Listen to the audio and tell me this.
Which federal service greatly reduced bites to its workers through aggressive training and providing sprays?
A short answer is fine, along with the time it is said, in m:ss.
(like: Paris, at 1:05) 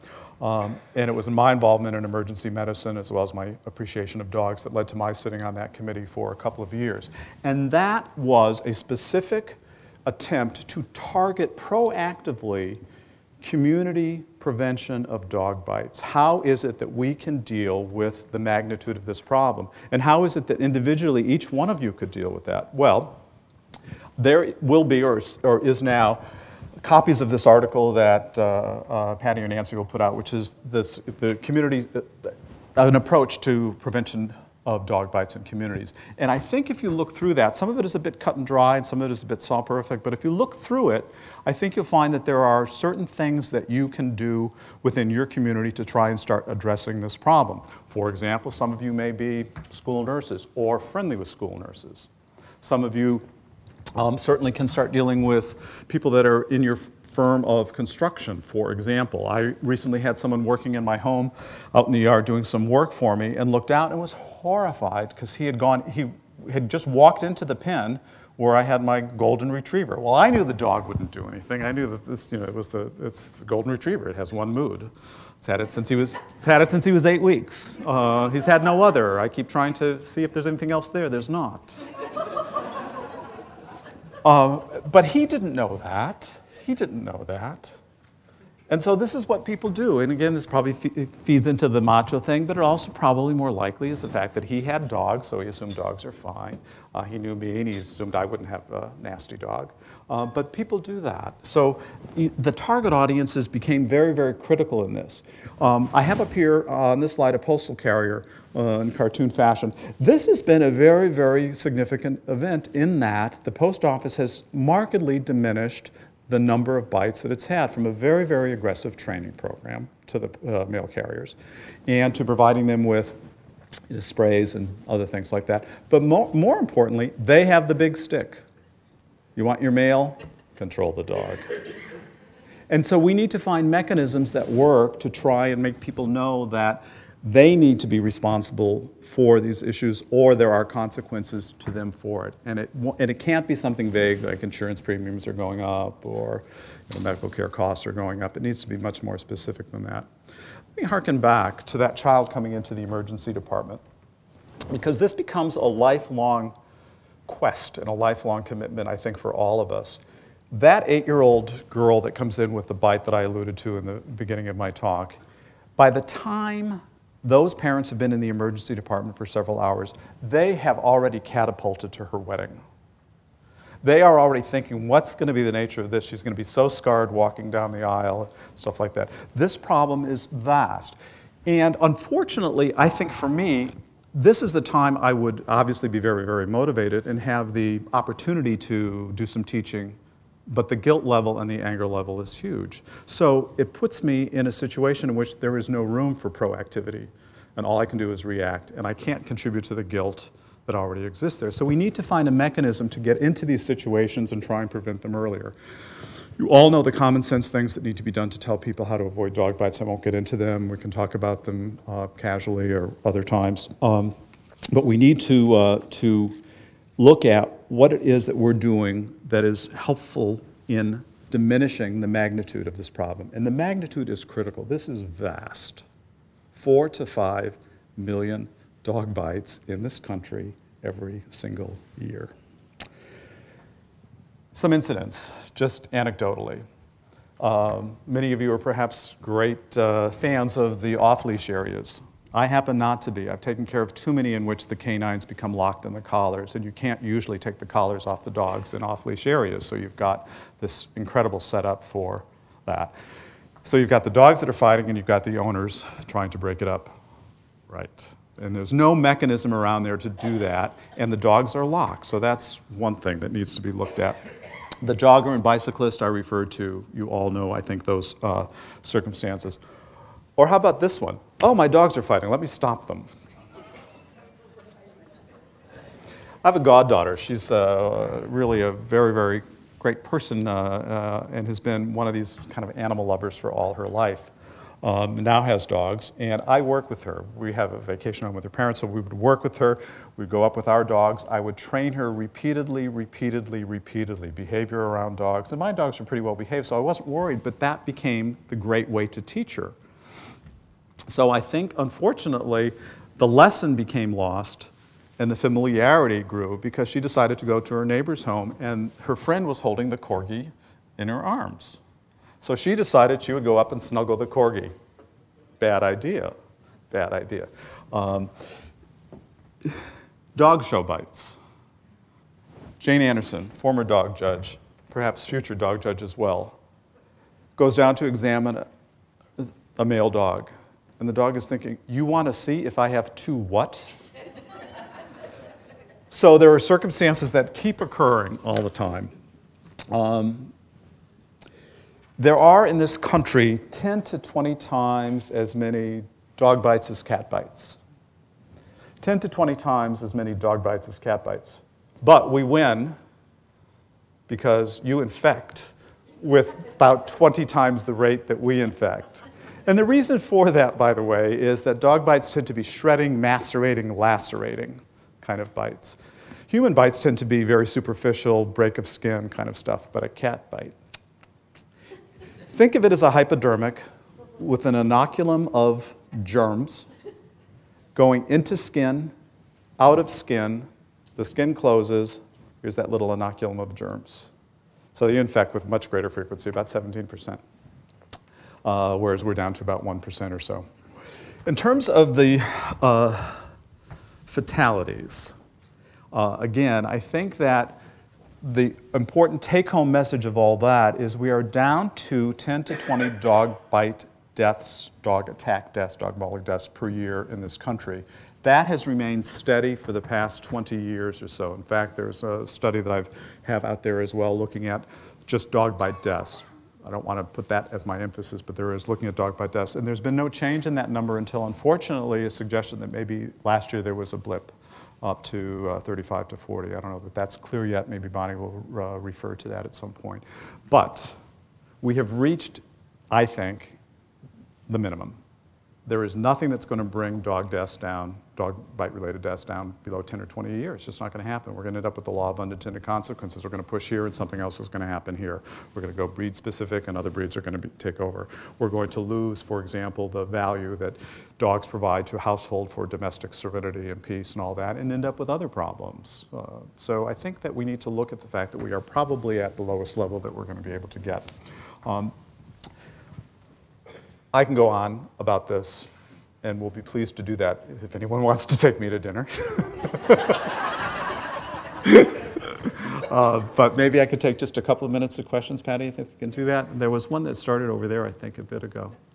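post office, at 1:53.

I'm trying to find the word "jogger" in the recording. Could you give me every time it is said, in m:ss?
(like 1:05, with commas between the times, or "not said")
4:24.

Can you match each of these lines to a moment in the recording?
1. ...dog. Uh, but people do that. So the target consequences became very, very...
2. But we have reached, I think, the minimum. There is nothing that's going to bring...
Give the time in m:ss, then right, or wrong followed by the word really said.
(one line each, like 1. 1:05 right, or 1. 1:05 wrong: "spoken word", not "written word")
1. 1:39 wrong: "audiences", not "consequences"
2. 7:10 right.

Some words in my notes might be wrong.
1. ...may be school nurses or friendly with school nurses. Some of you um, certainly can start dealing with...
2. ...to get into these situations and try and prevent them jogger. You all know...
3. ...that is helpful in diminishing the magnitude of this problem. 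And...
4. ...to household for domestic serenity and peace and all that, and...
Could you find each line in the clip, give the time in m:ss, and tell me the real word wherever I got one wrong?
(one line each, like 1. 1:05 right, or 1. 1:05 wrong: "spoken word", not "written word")
1. 0:48 right
2. 3:22 wrong: "earlier", not "jogger"
3. 3:39 right
4. 7:32 right.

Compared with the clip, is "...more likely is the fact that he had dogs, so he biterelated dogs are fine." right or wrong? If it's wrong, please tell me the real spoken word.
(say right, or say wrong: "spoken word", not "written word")
wrong: "assumed", not "biterelated".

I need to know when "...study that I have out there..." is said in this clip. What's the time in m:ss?
6:52.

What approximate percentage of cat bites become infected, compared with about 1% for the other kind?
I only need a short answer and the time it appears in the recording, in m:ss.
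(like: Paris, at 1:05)
17%, at 6:26.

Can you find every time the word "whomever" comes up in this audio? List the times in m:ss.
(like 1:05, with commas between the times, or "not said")
not said.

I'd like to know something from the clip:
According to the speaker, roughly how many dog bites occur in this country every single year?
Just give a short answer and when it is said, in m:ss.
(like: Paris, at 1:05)
4 to 5 million, at 3:46.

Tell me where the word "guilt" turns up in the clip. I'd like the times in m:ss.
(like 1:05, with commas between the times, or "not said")
3:10, 3:19.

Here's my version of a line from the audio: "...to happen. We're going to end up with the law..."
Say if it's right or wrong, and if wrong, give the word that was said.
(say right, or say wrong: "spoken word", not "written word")
right.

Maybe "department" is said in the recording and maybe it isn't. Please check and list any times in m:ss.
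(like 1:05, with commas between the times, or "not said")
2:33, 2:48.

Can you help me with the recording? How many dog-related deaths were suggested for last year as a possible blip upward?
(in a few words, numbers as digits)
35 to 40.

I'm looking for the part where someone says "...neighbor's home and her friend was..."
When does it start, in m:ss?
5:07.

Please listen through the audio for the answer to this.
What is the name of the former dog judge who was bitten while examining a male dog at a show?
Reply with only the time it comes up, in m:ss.
5:22.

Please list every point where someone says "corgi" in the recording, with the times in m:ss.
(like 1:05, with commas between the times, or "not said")
5:09, 5:14.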